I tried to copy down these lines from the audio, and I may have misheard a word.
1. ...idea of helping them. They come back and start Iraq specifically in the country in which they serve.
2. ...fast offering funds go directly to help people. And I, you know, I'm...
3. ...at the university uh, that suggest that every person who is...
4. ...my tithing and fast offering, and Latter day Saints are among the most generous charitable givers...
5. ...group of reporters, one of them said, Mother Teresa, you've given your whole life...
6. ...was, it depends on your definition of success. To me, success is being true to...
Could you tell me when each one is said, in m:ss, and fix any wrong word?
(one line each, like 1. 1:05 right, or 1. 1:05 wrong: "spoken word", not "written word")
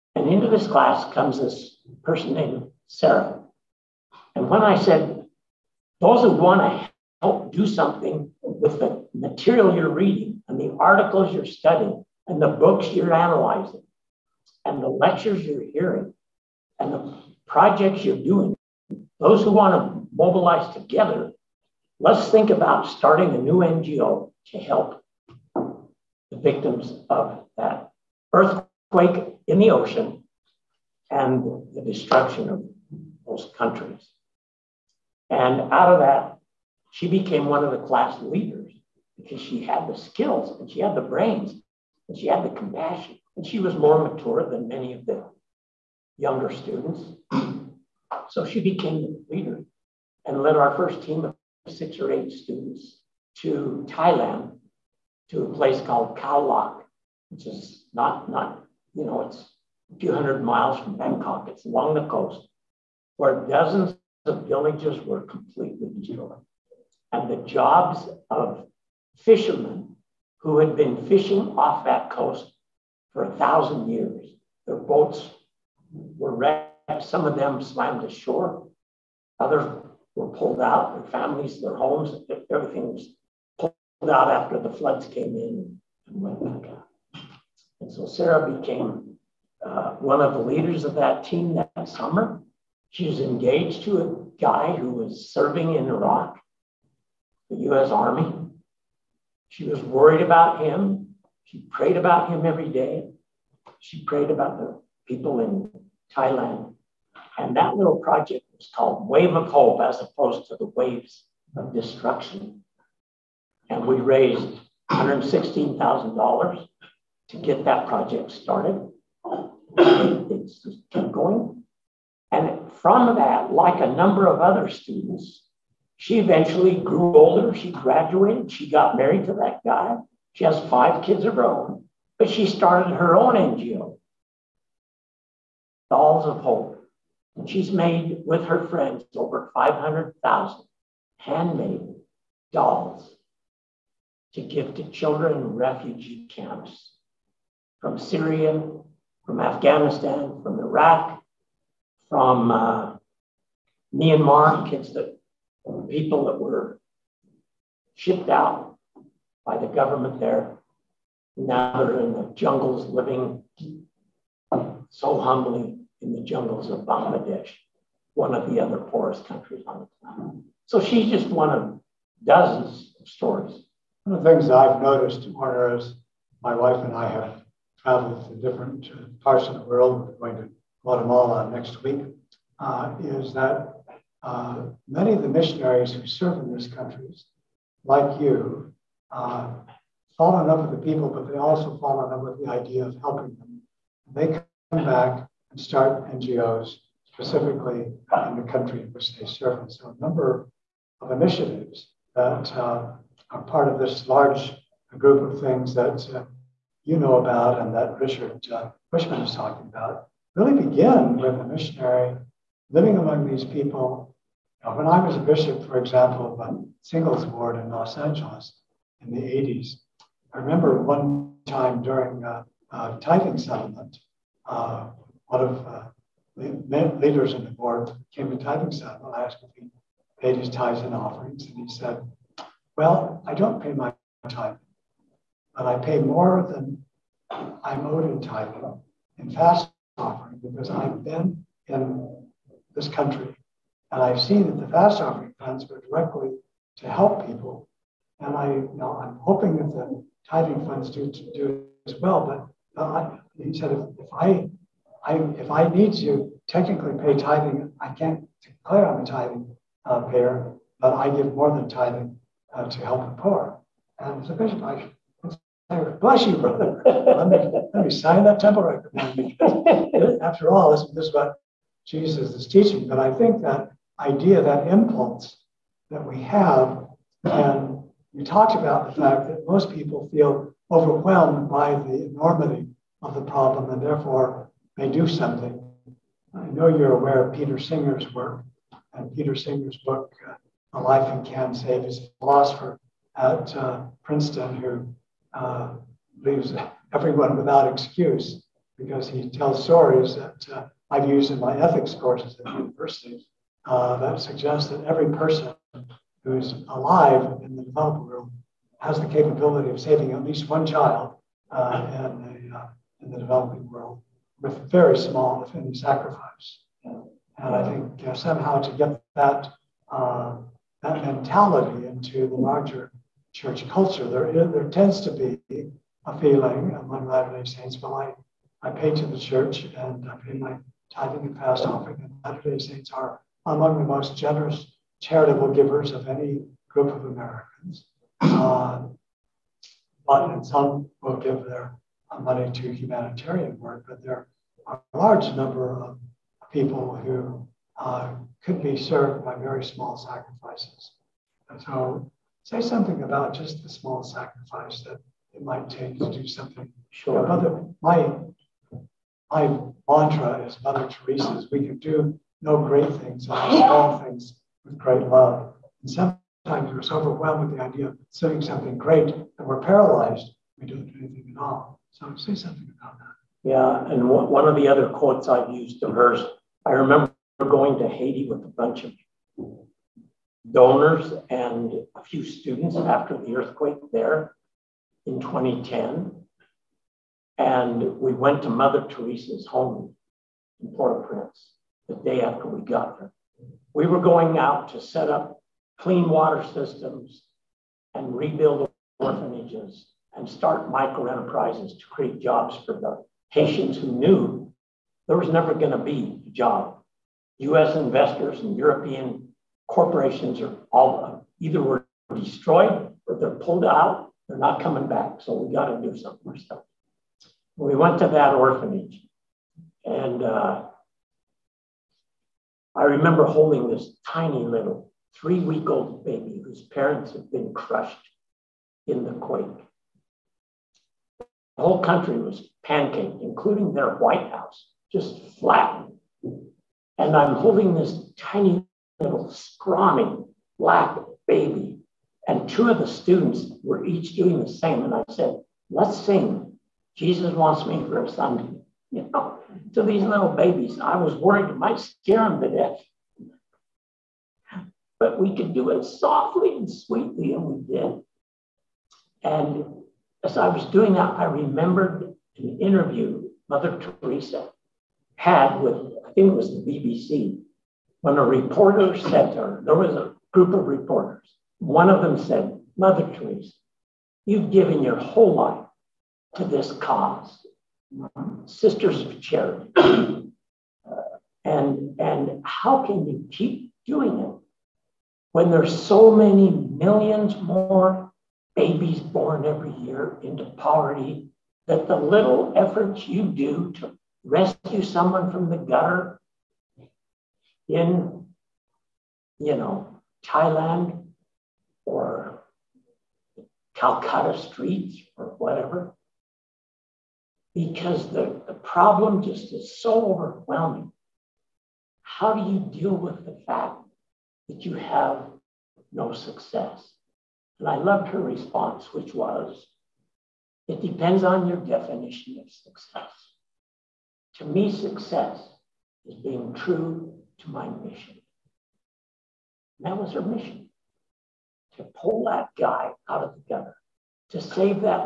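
1. 3:12 wrong: "NGOs", not "Iraq"
2. 4:04 right
3. 5:02 right
4. 5:30 right
5. 7:50 right
6. 8:39 right.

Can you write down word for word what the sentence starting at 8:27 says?
Because the, the problem just is so overwhelming.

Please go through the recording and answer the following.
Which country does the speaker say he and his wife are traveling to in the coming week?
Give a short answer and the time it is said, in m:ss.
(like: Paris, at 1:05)
Guatemala, at 3:00.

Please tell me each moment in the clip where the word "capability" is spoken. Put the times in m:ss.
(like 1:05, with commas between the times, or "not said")
5:09.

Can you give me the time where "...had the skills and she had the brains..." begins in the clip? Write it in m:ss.
0:39.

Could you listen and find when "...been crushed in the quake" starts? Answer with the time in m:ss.
7:07.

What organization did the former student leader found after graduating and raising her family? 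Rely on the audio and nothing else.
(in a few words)
Dolls of Hope.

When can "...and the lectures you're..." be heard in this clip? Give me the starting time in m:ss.
0:14.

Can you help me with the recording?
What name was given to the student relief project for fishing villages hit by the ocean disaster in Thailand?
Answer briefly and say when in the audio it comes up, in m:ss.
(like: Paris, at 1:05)
Wave of Hope, at 1:49.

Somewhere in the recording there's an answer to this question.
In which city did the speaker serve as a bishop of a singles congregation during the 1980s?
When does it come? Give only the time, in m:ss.
3:37.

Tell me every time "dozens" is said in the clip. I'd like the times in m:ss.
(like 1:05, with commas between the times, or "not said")
1:03, 2:52.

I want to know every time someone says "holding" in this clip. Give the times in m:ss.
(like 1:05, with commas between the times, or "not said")
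7:03, 7:17.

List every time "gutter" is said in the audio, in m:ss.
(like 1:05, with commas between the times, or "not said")
8:15, 8:53.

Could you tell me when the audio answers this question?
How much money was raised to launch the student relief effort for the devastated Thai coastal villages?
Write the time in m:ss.
1:54.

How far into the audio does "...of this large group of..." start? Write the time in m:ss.
3:23.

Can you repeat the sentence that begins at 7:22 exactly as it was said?
And two of the students were each doing the same.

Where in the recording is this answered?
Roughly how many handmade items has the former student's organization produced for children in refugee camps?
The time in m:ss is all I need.
2:19.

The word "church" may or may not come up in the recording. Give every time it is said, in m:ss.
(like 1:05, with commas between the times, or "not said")
5:23, 5:29.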